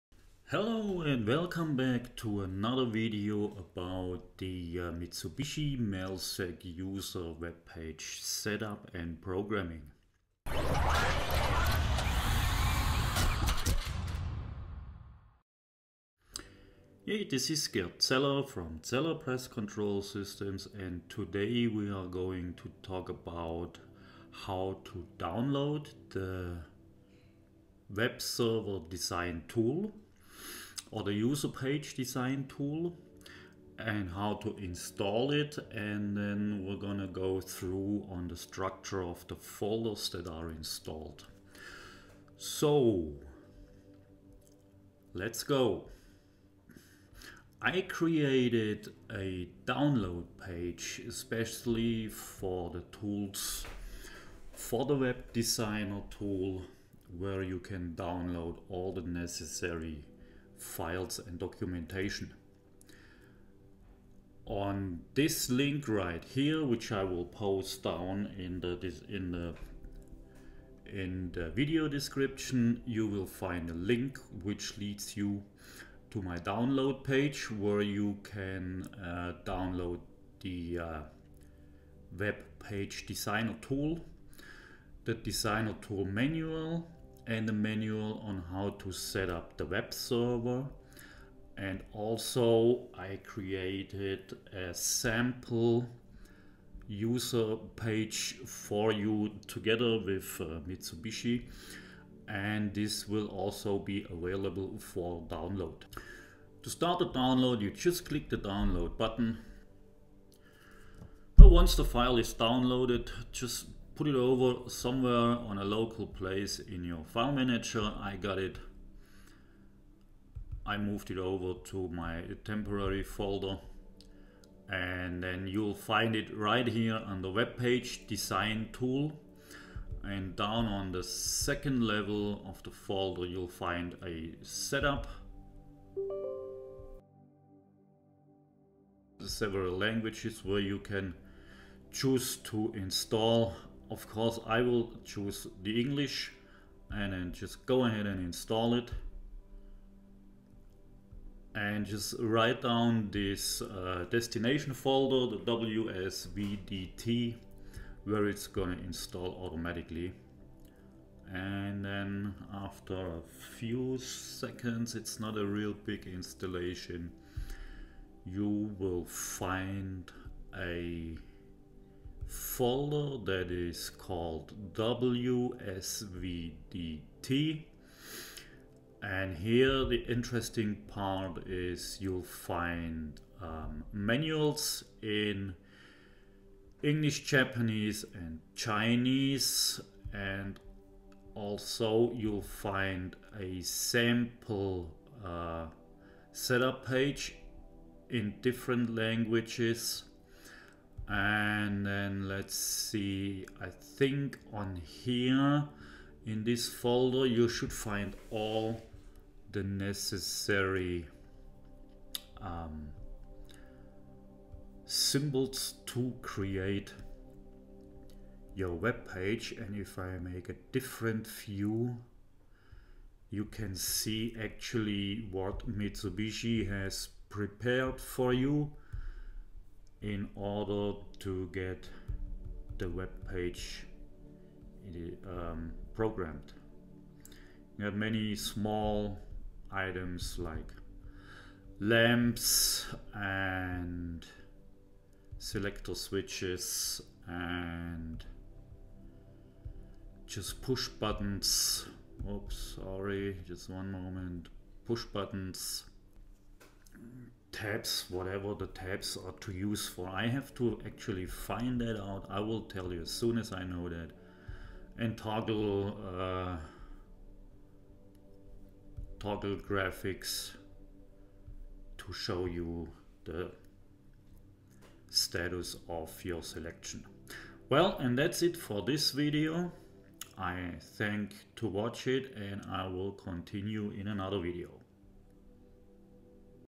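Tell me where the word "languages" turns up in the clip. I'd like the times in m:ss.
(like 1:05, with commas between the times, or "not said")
2:19, 3:18.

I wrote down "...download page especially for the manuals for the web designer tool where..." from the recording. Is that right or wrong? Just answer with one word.
wrong.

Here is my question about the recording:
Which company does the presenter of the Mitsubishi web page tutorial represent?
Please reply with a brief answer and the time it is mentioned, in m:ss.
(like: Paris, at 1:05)
Zeller Press Control Systems, at 0:18.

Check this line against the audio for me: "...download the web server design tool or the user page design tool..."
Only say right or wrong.
right.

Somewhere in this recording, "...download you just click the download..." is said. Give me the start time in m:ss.
1:47.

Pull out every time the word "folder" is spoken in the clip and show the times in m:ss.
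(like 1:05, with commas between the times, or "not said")
0:39, 2:03, 2:12, 2:34, 2:52, 3:26.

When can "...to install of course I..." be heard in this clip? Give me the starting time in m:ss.
2:22.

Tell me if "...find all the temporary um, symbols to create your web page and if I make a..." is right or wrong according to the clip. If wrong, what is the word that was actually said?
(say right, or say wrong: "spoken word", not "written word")
wrong: "necessary", not "temporary".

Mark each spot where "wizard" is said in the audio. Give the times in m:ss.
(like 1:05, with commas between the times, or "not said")
not said.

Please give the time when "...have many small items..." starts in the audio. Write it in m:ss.
3:57.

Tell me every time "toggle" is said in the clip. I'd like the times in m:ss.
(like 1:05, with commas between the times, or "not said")
4:25, 4:29.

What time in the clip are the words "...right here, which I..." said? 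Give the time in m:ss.
1:05.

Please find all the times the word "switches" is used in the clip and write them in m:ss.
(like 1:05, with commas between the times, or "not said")
4:05.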